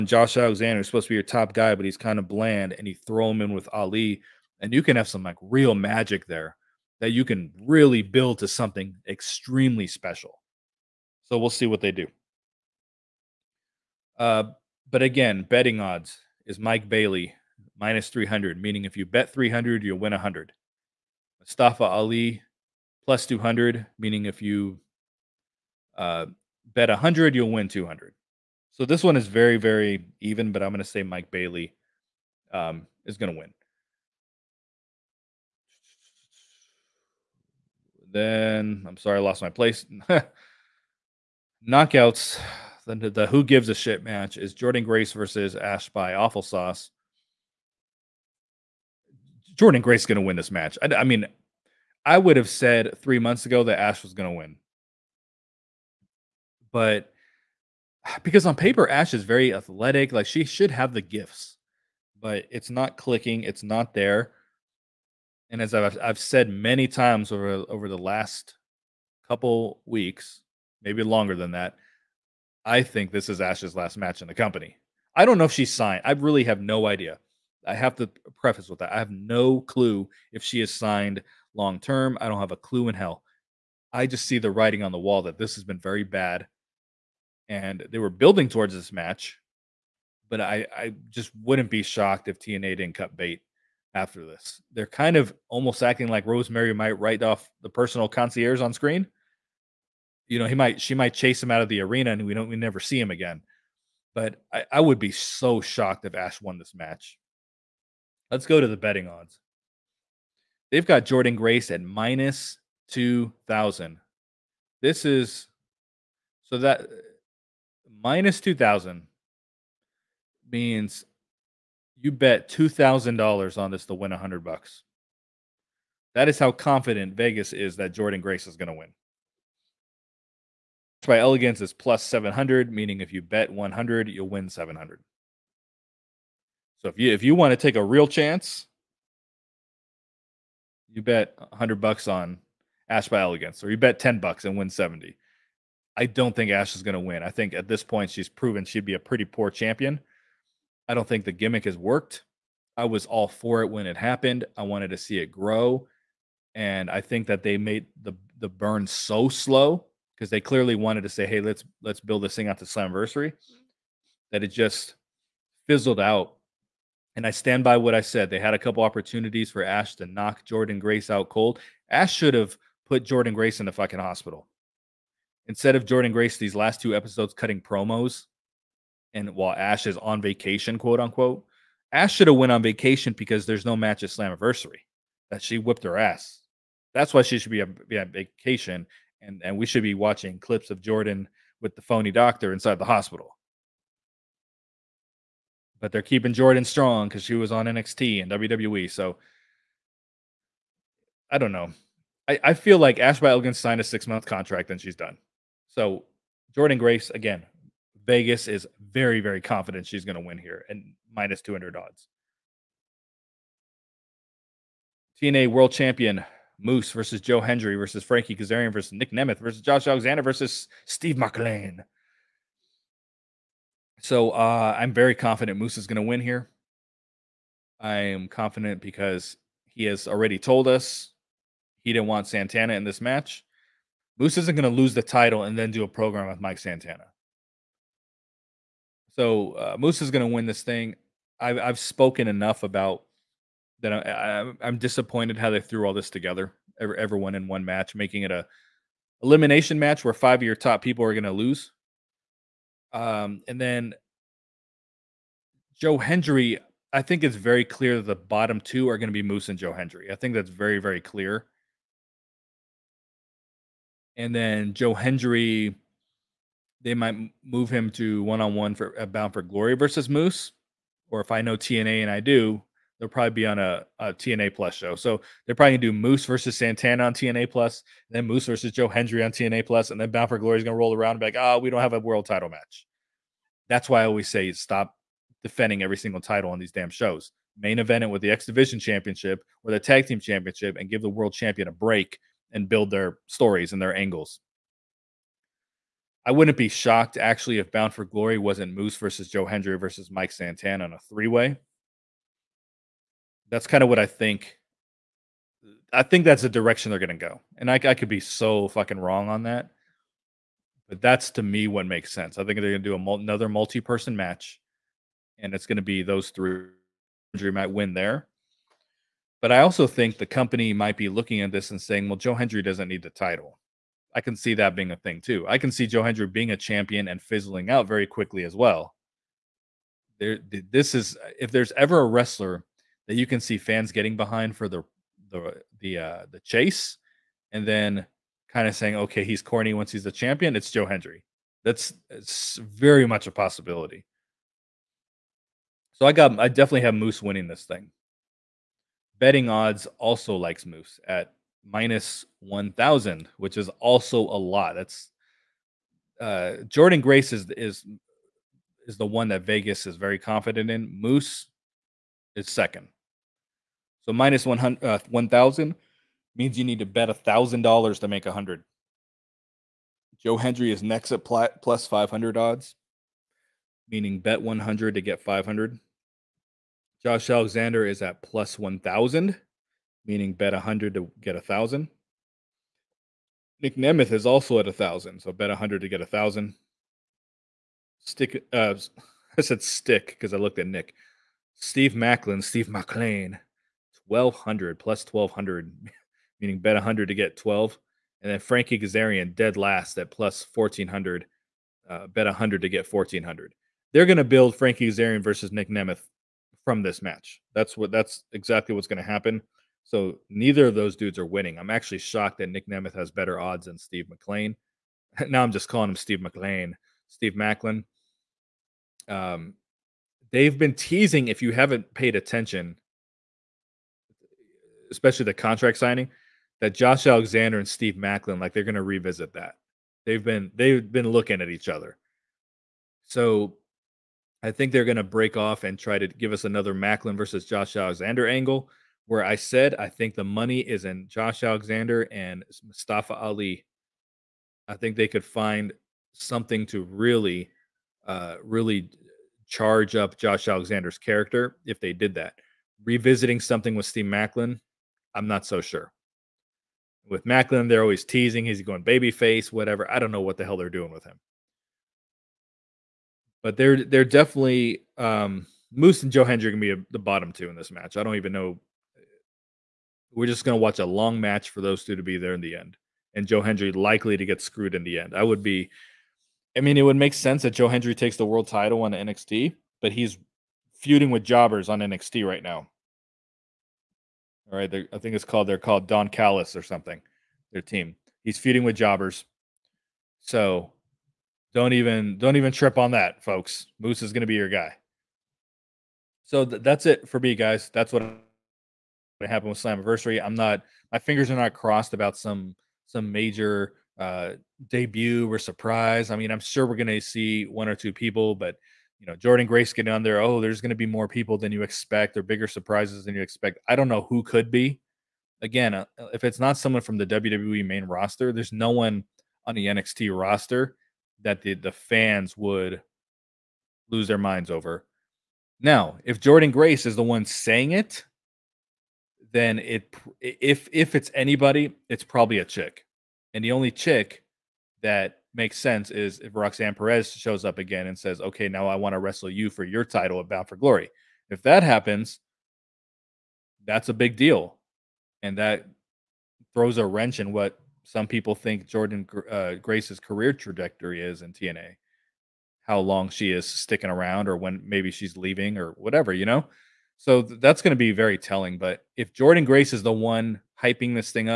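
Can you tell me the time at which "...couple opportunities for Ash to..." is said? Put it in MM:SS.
02:48.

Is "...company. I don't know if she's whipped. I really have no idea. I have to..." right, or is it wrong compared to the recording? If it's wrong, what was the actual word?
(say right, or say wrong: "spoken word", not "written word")
wrong: "signed", not "whipped".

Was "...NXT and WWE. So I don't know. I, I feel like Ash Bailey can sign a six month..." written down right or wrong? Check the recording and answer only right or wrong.
right.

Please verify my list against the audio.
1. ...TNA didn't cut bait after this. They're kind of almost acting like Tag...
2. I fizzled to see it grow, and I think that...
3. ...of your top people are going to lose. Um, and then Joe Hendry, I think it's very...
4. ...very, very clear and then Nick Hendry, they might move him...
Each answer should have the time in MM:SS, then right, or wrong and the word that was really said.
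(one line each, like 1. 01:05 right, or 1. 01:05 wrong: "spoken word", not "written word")
1. 01:32 wrong: "Rosemary", not "Tag"
2. 02:34 wrong: "wanted", not "fizzled"
3. 04:10 right
4. 04:20 wrong: "Joe", not "Nick".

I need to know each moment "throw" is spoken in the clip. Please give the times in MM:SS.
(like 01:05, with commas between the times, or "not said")
00:03, 09:06.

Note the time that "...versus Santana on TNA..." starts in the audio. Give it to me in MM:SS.
04:36.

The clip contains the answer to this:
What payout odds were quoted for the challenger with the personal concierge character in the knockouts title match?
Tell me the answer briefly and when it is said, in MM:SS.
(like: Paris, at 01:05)
+700, at 02:11.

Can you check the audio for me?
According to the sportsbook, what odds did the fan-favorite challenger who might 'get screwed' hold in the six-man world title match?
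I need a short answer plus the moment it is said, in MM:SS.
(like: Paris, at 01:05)
+500, at 06:11.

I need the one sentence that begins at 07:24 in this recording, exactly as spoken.
I think they could find something to really, uh, really charge up Josh Alexander's character if they did that.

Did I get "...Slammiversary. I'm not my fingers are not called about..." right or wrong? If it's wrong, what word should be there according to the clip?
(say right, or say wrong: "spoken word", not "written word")
wrong: "crossed", not "called".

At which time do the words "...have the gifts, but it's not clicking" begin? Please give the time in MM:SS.
01:00.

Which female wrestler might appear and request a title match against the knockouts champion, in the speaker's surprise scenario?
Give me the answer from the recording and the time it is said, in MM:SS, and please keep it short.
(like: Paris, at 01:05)
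Roxanne Perez, at 08:56.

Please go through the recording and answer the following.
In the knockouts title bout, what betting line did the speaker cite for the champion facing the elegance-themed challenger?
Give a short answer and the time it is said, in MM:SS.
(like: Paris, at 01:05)
-2000, at 01:51.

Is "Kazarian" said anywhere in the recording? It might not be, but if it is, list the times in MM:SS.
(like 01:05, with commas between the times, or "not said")
03:38, 06:38, 06:44.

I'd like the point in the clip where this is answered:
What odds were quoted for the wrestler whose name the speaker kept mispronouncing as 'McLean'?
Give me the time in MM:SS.
06:34.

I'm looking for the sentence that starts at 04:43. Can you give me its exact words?
That's why I always say stop defending every single title on these damn shows.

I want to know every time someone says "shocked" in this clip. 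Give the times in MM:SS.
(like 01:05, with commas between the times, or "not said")
01:31, 01:45, 04:56, 06:51.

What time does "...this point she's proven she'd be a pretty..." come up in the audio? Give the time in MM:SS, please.
02:27.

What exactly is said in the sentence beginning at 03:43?
So uh, I'm very confident Moose is going to win here.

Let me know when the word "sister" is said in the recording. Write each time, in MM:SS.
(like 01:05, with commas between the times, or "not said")
not said.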